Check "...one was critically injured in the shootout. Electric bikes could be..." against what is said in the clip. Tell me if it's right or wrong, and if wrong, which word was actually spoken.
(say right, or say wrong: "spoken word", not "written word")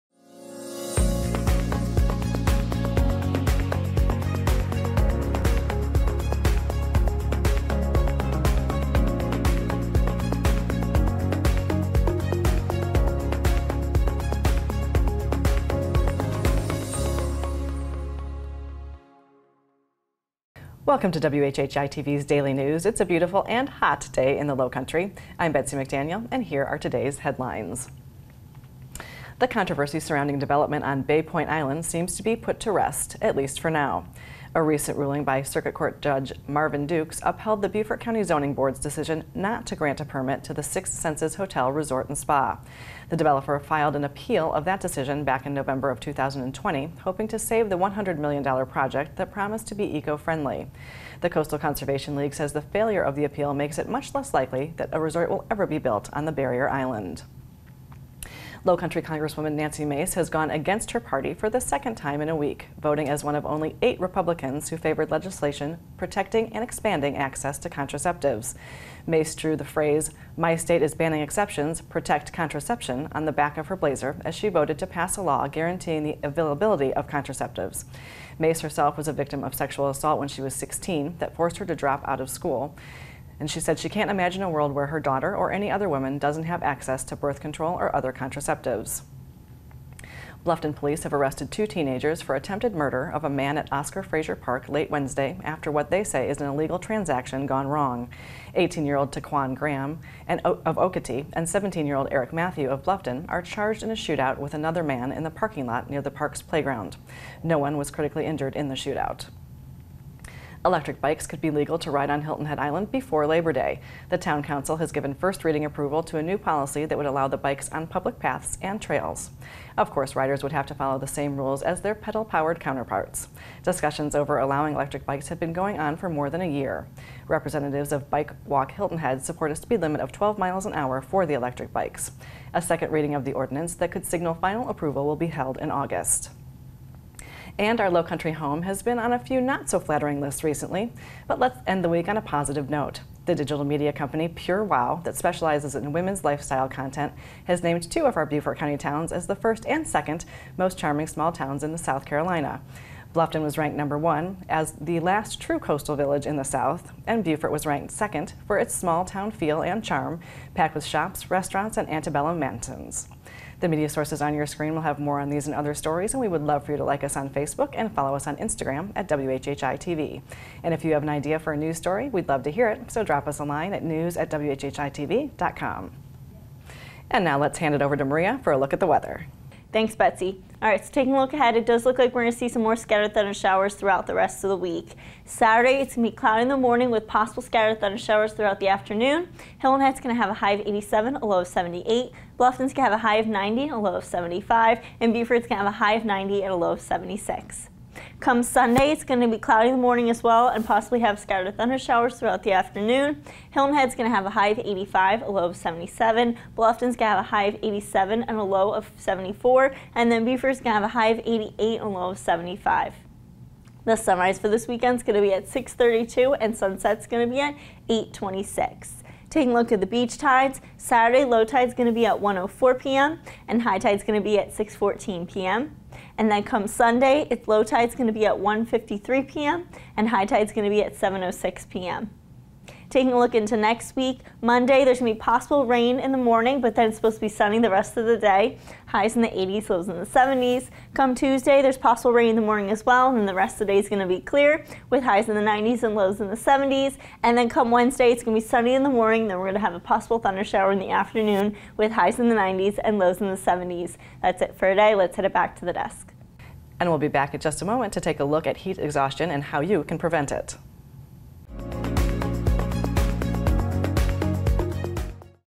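right.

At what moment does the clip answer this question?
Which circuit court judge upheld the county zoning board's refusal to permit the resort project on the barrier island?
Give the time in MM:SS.
00:36.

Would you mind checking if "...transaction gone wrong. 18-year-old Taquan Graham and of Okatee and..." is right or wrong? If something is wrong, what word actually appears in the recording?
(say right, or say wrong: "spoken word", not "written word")
right.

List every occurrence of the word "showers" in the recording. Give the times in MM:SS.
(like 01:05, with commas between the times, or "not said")
03:03, 03:07, 03:21, 04:10.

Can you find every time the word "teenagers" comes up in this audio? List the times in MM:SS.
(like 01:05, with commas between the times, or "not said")
01:31.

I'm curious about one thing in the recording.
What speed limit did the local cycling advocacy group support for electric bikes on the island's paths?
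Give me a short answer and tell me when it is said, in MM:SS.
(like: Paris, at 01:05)
12 miles an hour, at 02:10.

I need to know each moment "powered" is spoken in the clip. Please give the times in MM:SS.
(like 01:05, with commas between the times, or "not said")
02:01.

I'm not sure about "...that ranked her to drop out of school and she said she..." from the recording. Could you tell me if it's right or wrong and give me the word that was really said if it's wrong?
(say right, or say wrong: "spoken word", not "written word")
wrong: "forced", not "ranked".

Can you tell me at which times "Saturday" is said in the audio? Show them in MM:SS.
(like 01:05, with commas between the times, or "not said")
03:05, 03:40.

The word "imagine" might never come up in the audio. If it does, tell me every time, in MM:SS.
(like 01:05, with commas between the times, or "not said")
01:24.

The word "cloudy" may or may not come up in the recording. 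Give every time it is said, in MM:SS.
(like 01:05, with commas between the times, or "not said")
03:06, 03:19.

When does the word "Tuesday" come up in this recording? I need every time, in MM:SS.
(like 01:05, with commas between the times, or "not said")
04:01.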